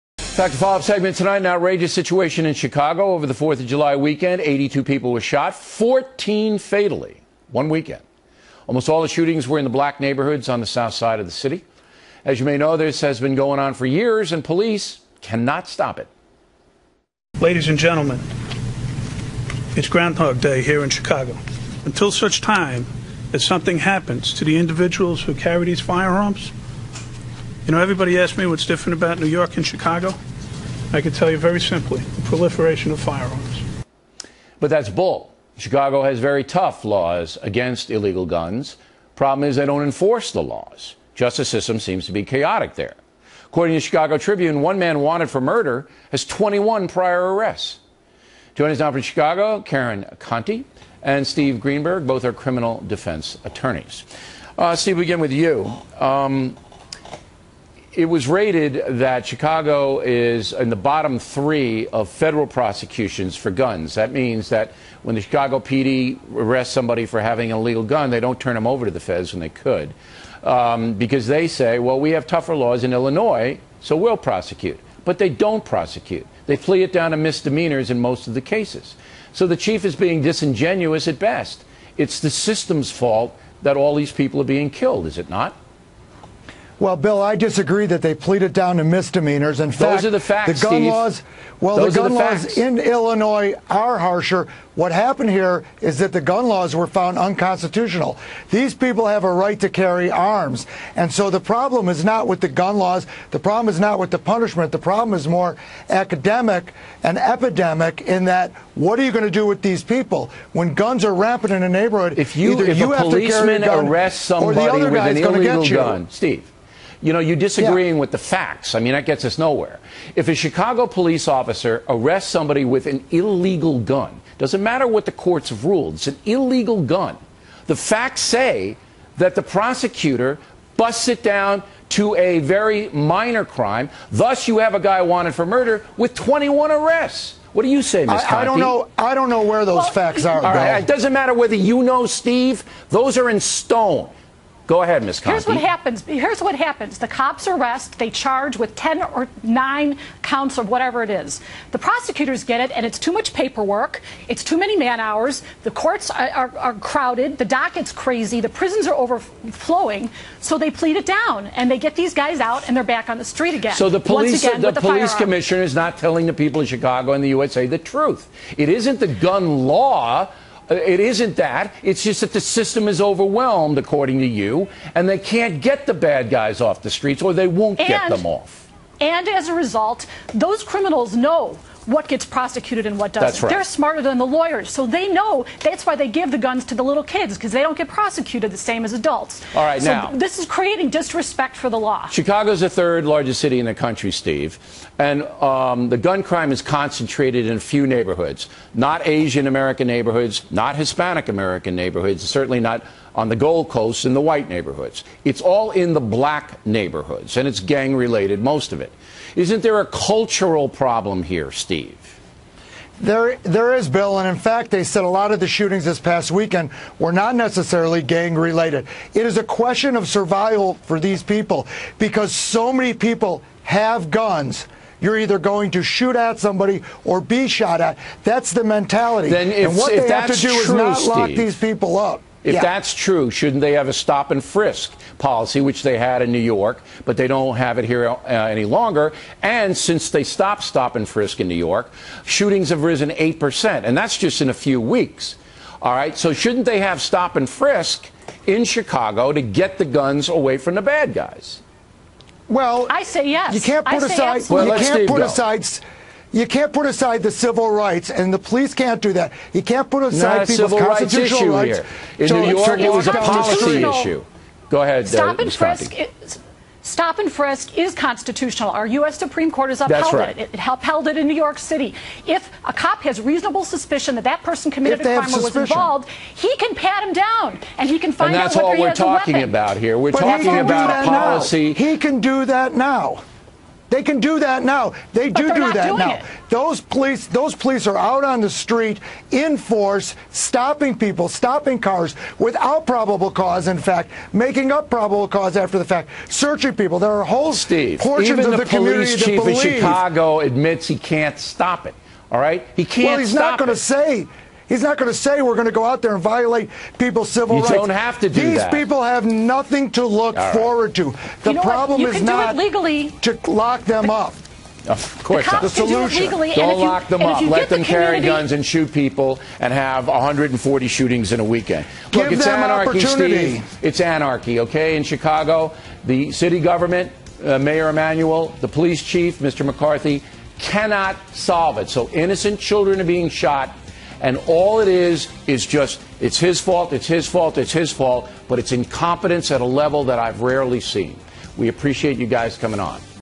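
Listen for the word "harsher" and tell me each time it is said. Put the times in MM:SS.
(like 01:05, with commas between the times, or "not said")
01:33.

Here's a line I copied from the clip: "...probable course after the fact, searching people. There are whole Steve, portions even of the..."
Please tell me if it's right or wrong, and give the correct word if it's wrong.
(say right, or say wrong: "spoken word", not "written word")
wrong: "cause", not "course".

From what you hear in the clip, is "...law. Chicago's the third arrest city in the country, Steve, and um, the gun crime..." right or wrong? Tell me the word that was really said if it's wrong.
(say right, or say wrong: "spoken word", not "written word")
wrong: "largest", not "arrest".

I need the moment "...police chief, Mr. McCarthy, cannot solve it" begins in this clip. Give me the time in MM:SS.
05:28.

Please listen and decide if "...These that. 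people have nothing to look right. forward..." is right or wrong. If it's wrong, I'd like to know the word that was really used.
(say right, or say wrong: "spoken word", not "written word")
right.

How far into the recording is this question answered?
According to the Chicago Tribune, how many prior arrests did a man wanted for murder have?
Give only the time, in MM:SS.
00:46.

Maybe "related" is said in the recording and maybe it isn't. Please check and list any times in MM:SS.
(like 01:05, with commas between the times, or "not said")
03:27, 03:38.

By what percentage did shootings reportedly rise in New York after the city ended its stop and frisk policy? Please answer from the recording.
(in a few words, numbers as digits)
8%.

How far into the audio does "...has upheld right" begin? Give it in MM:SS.
04:29.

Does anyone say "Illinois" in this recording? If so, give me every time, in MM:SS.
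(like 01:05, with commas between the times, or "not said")
01:12, 01:32.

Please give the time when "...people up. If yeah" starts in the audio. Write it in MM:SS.
03:51.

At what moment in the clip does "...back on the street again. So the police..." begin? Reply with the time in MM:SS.
02:42.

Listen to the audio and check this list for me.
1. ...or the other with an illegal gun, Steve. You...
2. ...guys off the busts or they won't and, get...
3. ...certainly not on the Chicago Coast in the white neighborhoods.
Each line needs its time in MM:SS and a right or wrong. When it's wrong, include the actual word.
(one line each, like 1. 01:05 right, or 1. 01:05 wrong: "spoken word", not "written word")
1. 01:54 right
2. 02:56 wrong: "streets", not "busts"
3. 03:22 wrong: "Gold", not "Chicago".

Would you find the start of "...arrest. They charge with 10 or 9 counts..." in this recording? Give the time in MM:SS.
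02:27.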